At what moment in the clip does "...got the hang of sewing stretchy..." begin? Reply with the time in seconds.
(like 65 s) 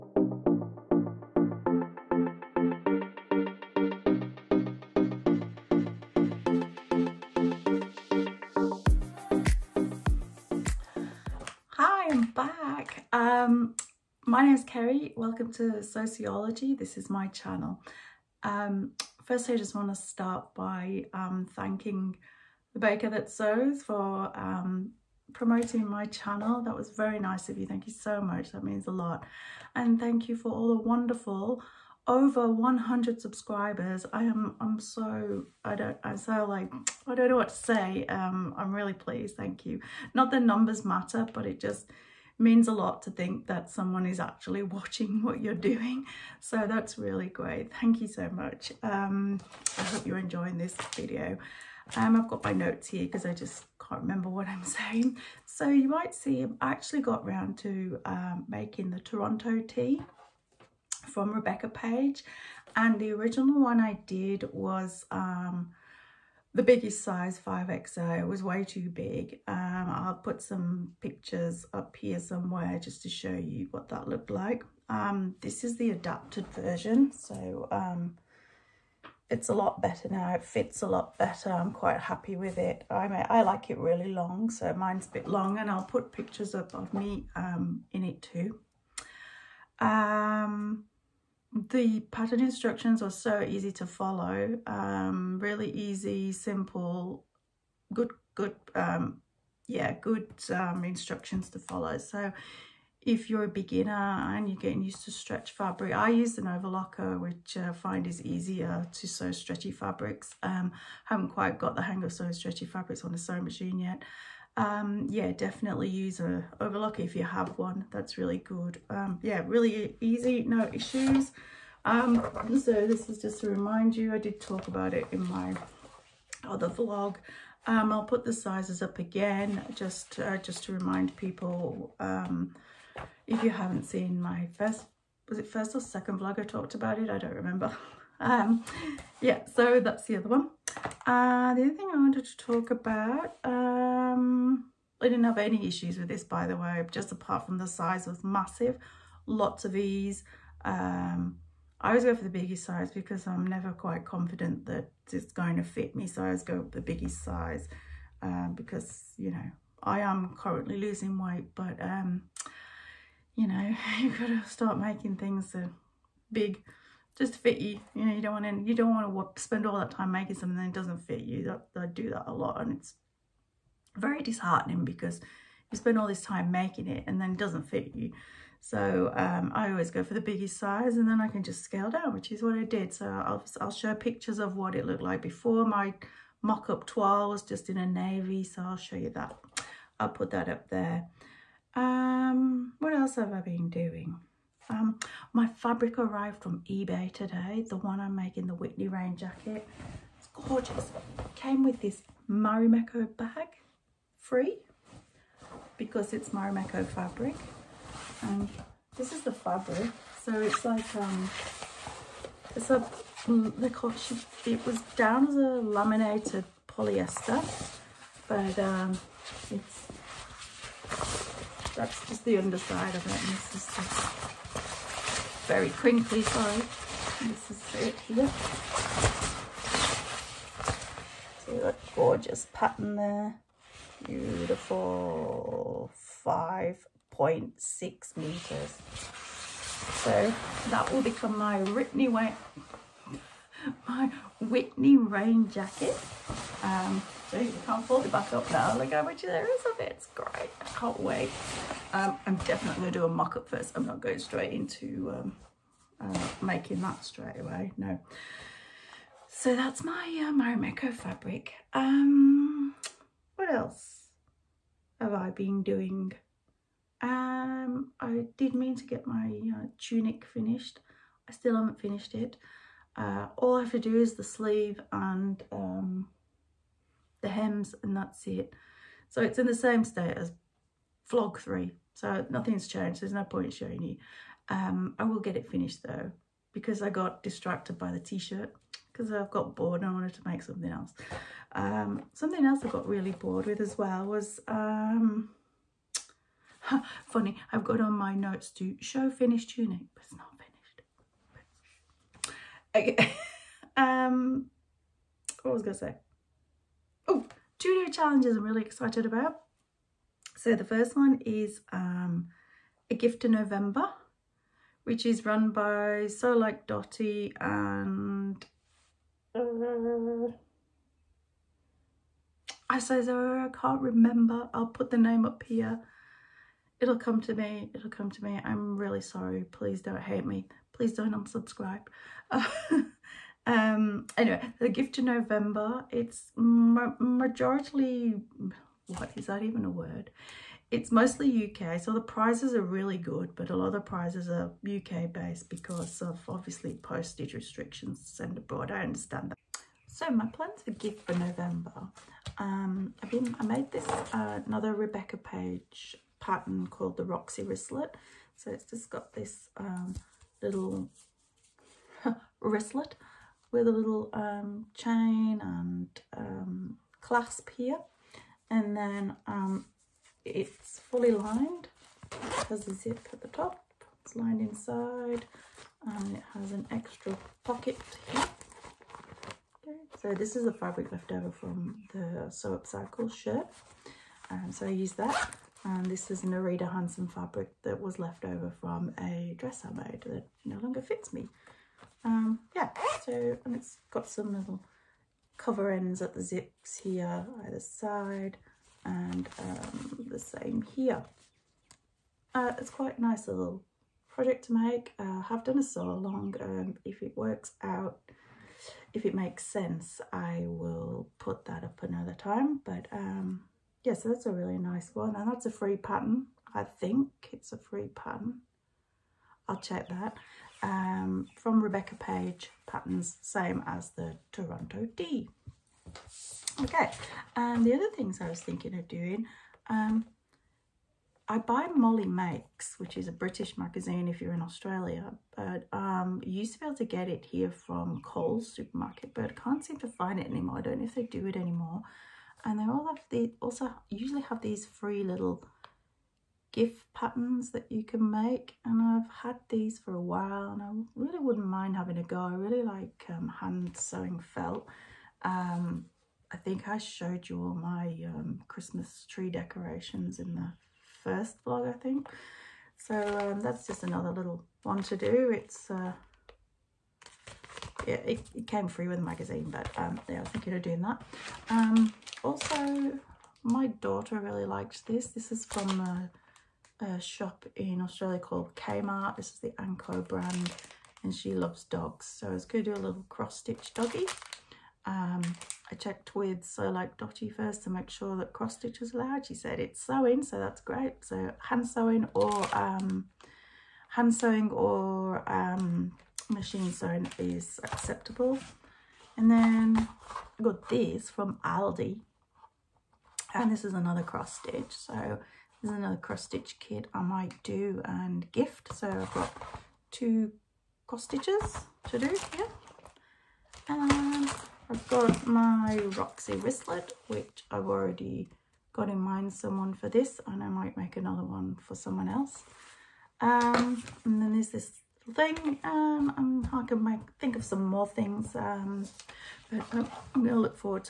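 111 s.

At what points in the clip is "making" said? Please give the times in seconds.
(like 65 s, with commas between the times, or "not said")
58 s, 164 s, 170 s, 176 s, 198 s, 256 s.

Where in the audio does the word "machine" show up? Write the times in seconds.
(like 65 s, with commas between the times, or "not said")
113 s, 496 s.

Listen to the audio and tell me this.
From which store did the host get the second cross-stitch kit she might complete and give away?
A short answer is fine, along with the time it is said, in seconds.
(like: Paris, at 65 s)
Aldi, at 501 s.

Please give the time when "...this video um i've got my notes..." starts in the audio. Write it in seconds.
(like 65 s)
50 s.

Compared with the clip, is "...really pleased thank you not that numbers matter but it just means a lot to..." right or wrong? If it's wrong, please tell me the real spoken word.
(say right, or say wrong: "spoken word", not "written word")
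right.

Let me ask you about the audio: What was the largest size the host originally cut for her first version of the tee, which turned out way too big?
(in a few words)
5XO.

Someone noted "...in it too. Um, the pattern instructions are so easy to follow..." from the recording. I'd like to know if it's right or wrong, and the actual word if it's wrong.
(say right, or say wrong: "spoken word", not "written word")
right.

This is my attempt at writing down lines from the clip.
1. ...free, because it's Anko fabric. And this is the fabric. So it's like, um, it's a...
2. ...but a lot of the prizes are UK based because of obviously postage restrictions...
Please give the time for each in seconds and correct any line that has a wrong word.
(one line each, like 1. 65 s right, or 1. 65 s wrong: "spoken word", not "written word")
1. 204 s wrong: "Marimekko", not "Anko"
2. 343 s right.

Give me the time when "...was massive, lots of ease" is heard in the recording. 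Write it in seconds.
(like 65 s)
148 s.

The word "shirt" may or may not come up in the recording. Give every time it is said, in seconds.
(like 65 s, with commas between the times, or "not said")
288 s, 383 s.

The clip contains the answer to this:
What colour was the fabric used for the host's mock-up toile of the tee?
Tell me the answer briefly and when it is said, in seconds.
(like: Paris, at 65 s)
navy, at 187 s.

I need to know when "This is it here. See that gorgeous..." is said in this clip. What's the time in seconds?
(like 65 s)
227 s.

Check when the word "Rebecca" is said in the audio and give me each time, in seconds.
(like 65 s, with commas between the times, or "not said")
61 s, 354 s, 421 s.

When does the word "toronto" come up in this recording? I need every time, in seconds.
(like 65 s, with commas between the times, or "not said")
59 s, 424 s.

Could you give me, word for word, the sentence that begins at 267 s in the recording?
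Um, I did mean to get my uh, tunic finished.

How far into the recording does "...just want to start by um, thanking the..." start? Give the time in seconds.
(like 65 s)
19 s.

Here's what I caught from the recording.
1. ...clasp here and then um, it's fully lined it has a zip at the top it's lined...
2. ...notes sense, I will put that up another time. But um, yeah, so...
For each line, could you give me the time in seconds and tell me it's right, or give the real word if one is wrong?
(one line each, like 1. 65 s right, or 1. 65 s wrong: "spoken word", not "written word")
1. 367 s right
2. 409 s wrong: "makes", not "notes".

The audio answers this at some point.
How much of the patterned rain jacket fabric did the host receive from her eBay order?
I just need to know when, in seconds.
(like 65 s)
236 s.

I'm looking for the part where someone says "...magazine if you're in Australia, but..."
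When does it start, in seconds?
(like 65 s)
433 s.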